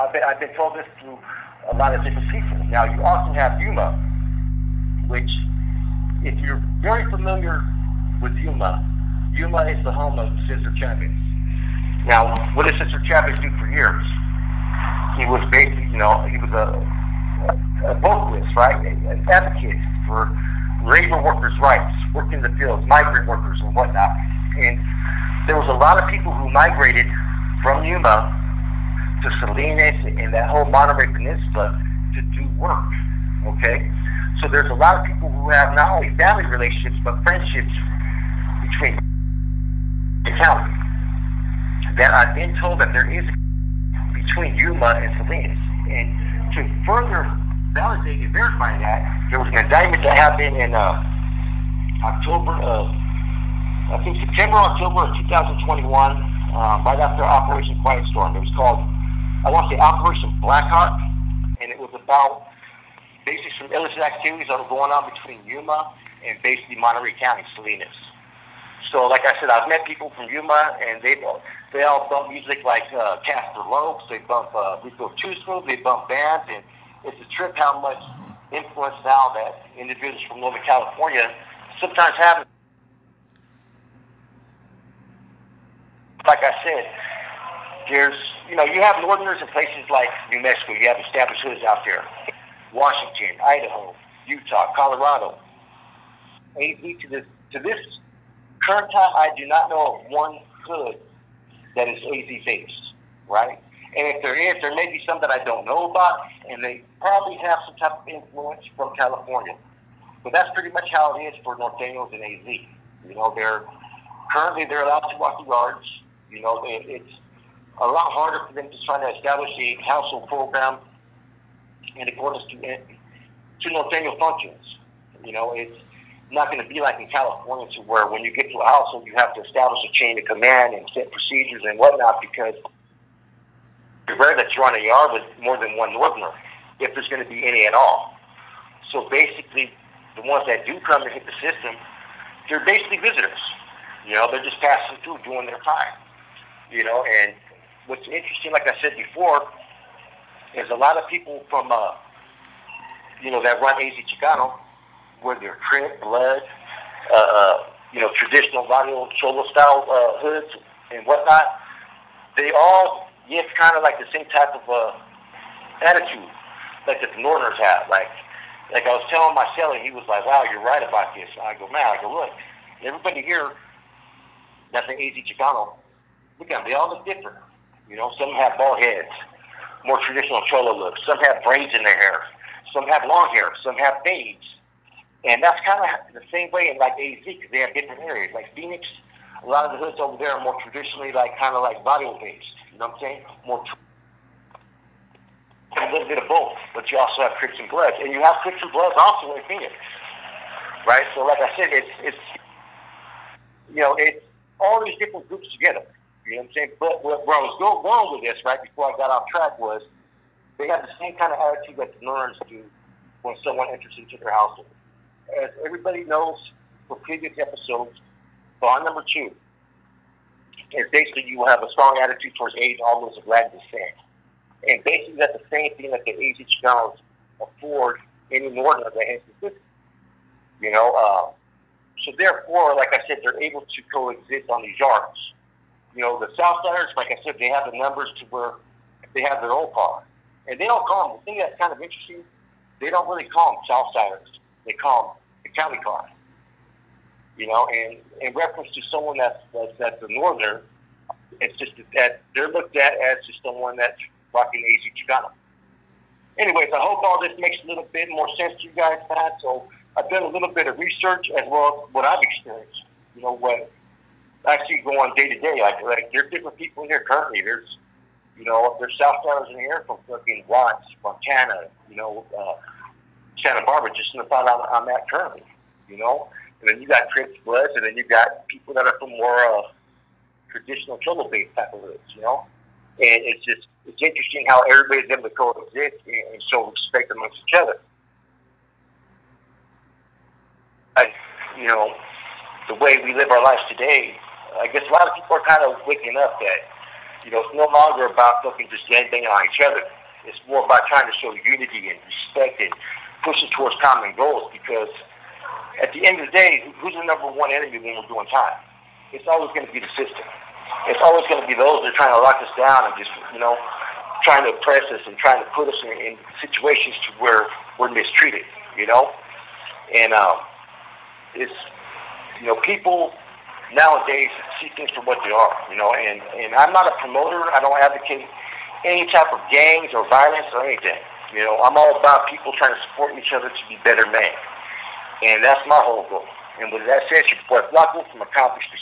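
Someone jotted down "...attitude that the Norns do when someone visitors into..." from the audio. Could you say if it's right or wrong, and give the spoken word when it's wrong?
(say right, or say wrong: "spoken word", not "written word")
wrong: "enters", not "visitors".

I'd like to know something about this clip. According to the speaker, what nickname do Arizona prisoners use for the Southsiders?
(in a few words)
county cars.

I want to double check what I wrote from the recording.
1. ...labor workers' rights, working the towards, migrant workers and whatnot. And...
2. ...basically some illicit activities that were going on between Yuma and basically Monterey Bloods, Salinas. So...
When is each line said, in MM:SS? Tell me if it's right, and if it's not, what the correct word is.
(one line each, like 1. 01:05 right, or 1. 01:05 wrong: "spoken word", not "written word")
1. 00:20 wrong: "fields", not "towards"
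2. 01:03 wrong: "County", not "Bloods".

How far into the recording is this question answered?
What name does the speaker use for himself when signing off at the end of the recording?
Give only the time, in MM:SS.
05:37.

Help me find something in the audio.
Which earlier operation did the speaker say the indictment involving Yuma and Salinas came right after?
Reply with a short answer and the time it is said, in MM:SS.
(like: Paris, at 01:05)
Operation Quiet Storm, at 00:57.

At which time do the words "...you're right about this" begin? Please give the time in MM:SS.
02:50.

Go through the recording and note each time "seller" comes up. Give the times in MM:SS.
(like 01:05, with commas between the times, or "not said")
02:49.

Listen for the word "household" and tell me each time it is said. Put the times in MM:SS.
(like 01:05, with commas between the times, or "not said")
01:59, 02:08, 03:34.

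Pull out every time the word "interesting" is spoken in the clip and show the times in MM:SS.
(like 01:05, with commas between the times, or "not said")
02:28, 04:01, 04:44.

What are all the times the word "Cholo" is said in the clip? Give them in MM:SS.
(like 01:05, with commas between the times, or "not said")
02:39, 03:00.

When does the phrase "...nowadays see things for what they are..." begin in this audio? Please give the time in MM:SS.
05:23.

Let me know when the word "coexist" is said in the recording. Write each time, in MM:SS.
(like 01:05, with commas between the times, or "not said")
03:53, 04:45.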